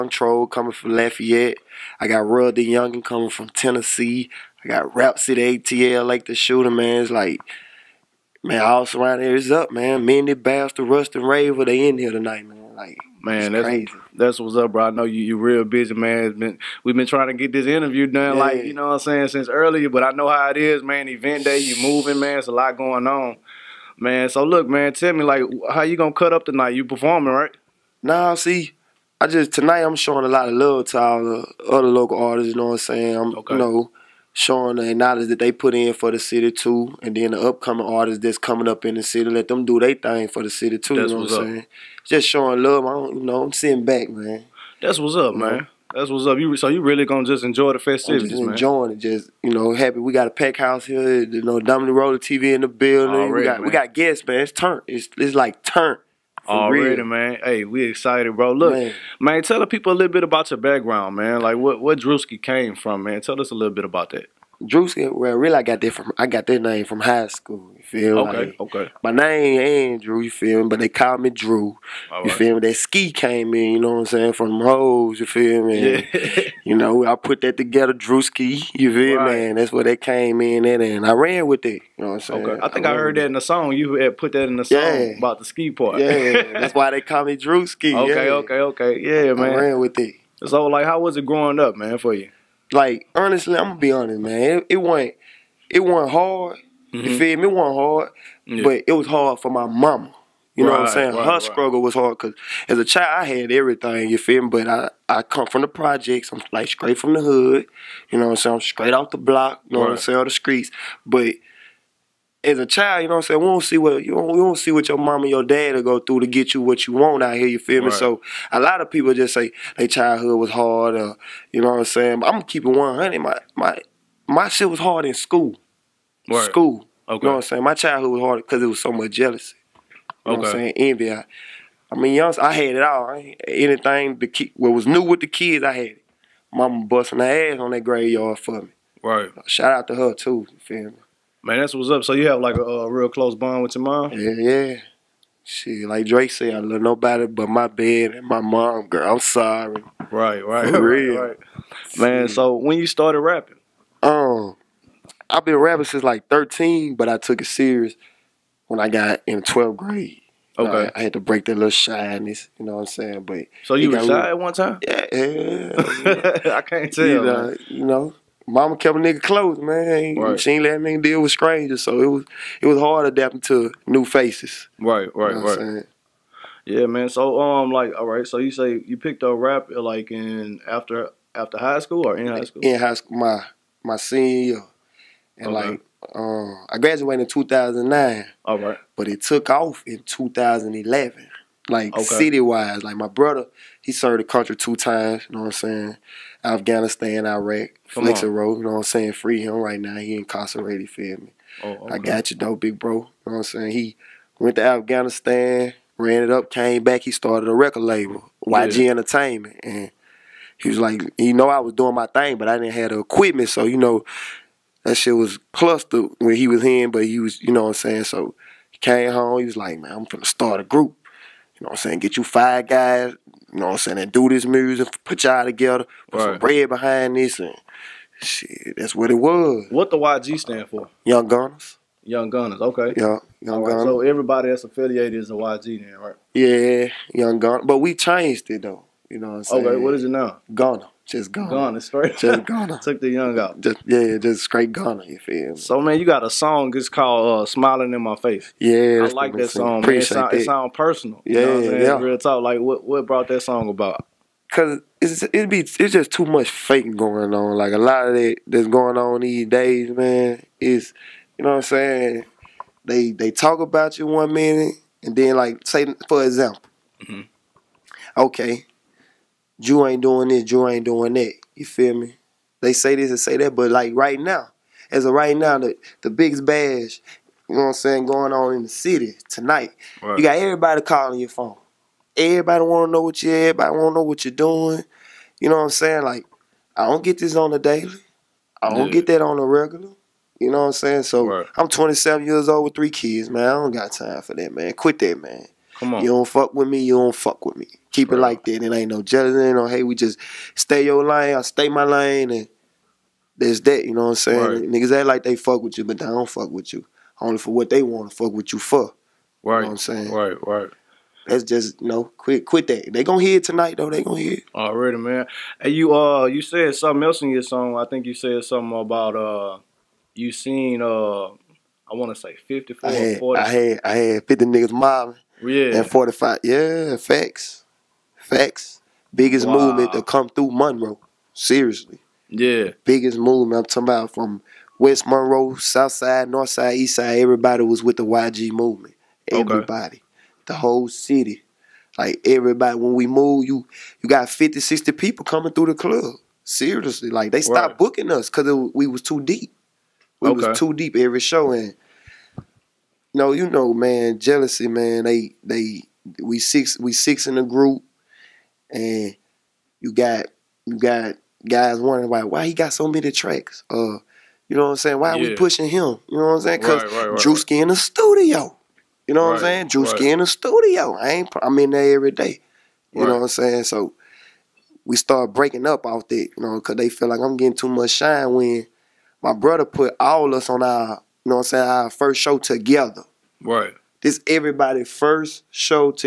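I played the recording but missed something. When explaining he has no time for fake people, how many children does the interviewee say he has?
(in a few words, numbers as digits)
3.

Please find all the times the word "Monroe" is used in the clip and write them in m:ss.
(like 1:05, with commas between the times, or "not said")
5:30, 5:35.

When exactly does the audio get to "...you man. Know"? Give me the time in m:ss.
0:45.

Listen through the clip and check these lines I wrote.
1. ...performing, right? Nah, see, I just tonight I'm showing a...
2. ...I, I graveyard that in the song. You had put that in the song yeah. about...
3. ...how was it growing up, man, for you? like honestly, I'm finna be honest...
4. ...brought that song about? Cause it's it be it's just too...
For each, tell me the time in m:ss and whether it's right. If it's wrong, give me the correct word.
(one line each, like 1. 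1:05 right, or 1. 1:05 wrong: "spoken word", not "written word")
1. 0:26 right
2. 1:22 wrong: "heard", not "graveyard"
3. 1:30 wrong: "gonna", not "finna"
4. 4:13 right.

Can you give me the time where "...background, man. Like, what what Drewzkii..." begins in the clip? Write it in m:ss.
1:00.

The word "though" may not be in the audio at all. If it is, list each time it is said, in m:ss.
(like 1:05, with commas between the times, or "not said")
3:22, 3:58, 5:13.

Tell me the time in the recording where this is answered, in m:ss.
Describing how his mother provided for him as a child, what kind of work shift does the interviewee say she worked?
2:17.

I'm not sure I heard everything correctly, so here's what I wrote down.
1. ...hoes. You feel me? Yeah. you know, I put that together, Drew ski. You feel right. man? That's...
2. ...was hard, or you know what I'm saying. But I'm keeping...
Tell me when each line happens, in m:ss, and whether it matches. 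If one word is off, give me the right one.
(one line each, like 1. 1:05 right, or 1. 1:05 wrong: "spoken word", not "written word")
1. 1:14 right
2. 2:00 right.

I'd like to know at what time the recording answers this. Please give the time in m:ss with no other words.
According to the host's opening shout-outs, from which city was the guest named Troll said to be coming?
0:00.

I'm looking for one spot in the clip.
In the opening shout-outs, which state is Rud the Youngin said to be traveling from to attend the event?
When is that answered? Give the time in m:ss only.
0:03.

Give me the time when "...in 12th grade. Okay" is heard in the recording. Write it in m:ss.
2:39.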